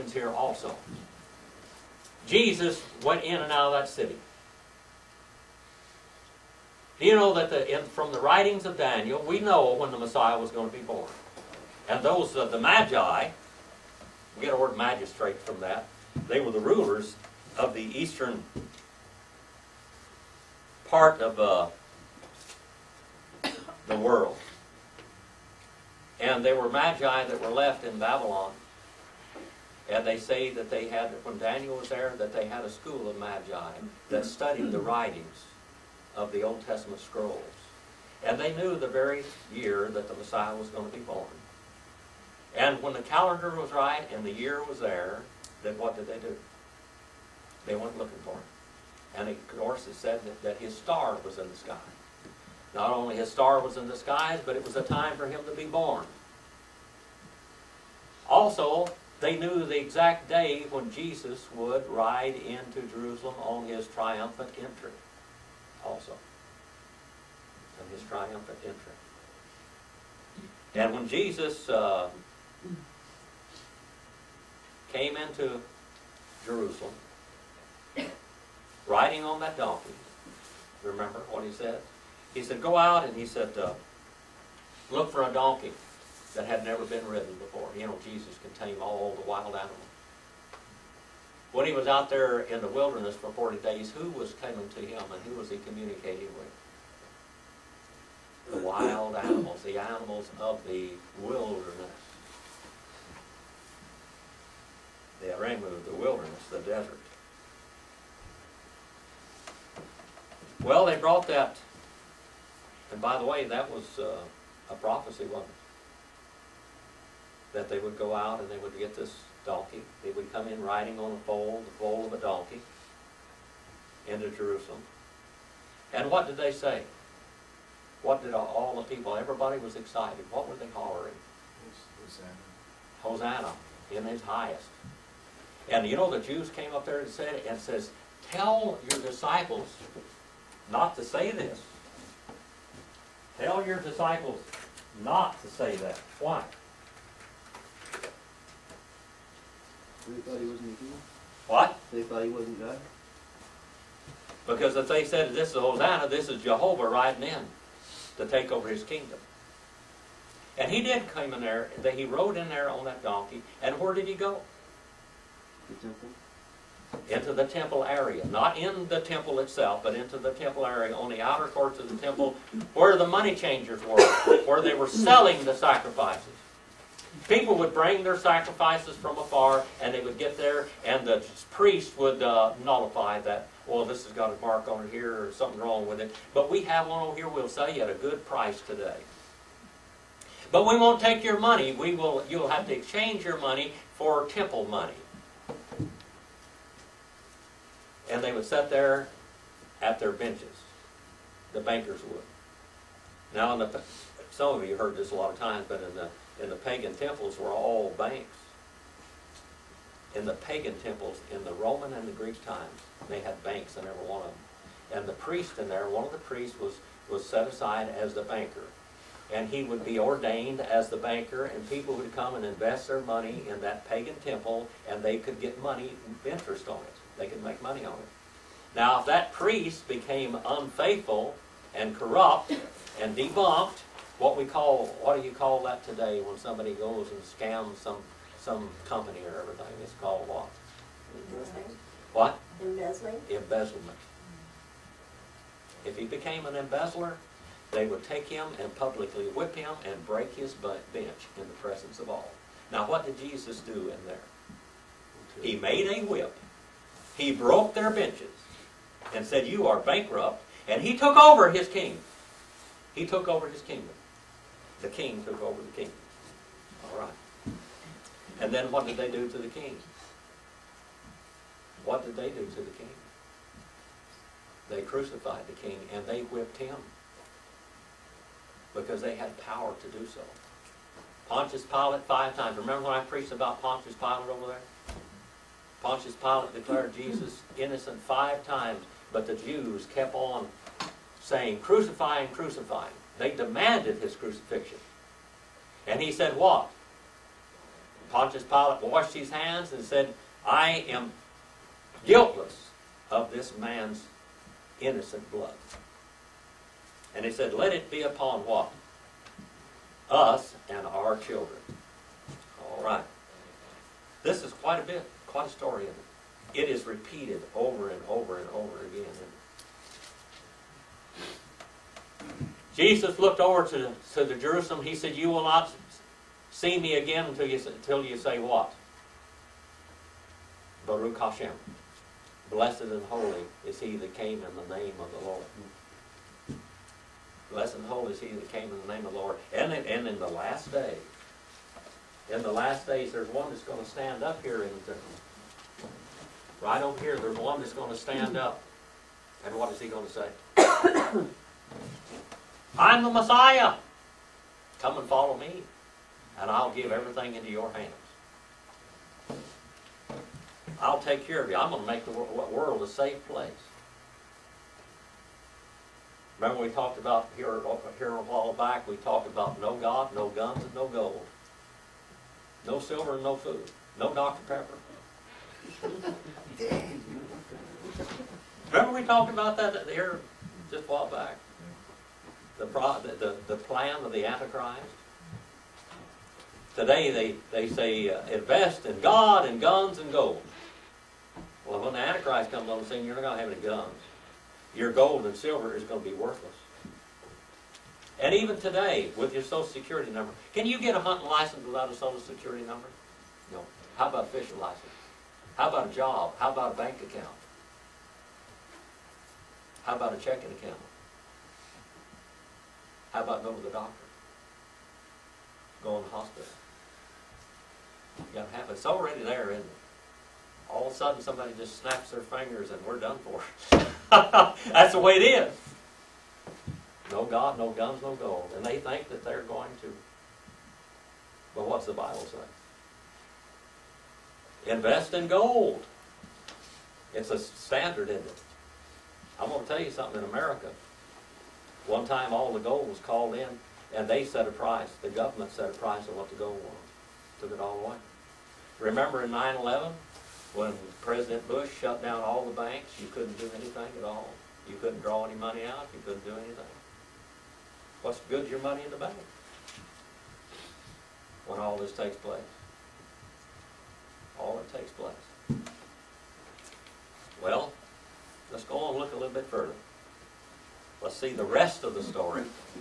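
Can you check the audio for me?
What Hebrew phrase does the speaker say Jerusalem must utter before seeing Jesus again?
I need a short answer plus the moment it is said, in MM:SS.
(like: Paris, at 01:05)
Baruch Hashem, at 05:30.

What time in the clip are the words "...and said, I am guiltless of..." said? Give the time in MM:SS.
04:59.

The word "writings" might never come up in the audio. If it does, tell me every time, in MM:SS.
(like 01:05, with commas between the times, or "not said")
00:08, 00:34.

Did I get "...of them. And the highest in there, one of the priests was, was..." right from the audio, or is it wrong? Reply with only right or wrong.
wrong.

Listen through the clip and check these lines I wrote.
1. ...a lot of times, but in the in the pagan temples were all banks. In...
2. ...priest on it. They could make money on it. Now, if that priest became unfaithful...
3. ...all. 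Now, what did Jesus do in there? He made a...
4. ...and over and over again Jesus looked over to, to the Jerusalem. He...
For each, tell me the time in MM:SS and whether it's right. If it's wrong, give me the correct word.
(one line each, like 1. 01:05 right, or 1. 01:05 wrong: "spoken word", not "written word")
1. 03:25 right
2. 03:46 wrong: "interest", not "priest"
3. 04:12 right
4. 05:17 right.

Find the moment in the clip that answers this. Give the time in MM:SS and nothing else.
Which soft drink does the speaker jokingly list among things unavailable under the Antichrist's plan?
06:14.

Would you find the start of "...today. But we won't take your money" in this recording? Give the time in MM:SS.
03:08.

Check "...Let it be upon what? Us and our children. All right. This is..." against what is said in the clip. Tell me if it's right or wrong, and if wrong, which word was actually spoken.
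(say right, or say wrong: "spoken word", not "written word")
right.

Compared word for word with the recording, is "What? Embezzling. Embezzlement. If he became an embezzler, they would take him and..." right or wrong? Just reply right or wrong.
right.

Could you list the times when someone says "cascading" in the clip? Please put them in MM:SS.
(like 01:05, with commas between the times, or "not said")
not said.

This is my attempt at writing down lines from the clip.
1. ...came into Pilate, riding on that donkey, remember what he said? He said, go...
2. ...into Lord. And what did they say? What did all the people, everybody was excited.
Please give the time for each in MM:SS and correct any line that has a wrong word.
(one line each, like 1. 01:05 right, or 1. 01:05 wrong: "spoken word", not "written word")
1. 01:14 wrong: "Jerusalem", not "Pilate"
2. 02:04 wrong: "Jerusalem", not "Lord".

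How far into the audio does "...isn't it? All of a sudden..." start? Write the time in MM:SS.
06:59.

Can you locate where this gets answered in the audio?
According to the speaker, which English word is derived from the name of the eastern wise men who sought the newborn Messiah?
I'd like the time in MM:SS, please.
00:14.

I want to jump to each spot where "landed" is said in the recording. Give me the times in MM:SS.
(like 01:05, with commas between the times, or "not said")
not said.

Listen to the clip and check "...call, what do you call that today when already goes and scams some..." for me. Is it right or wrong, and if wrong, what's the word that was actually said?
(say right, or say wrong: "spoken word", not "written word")
wrong: "somebody", not "already".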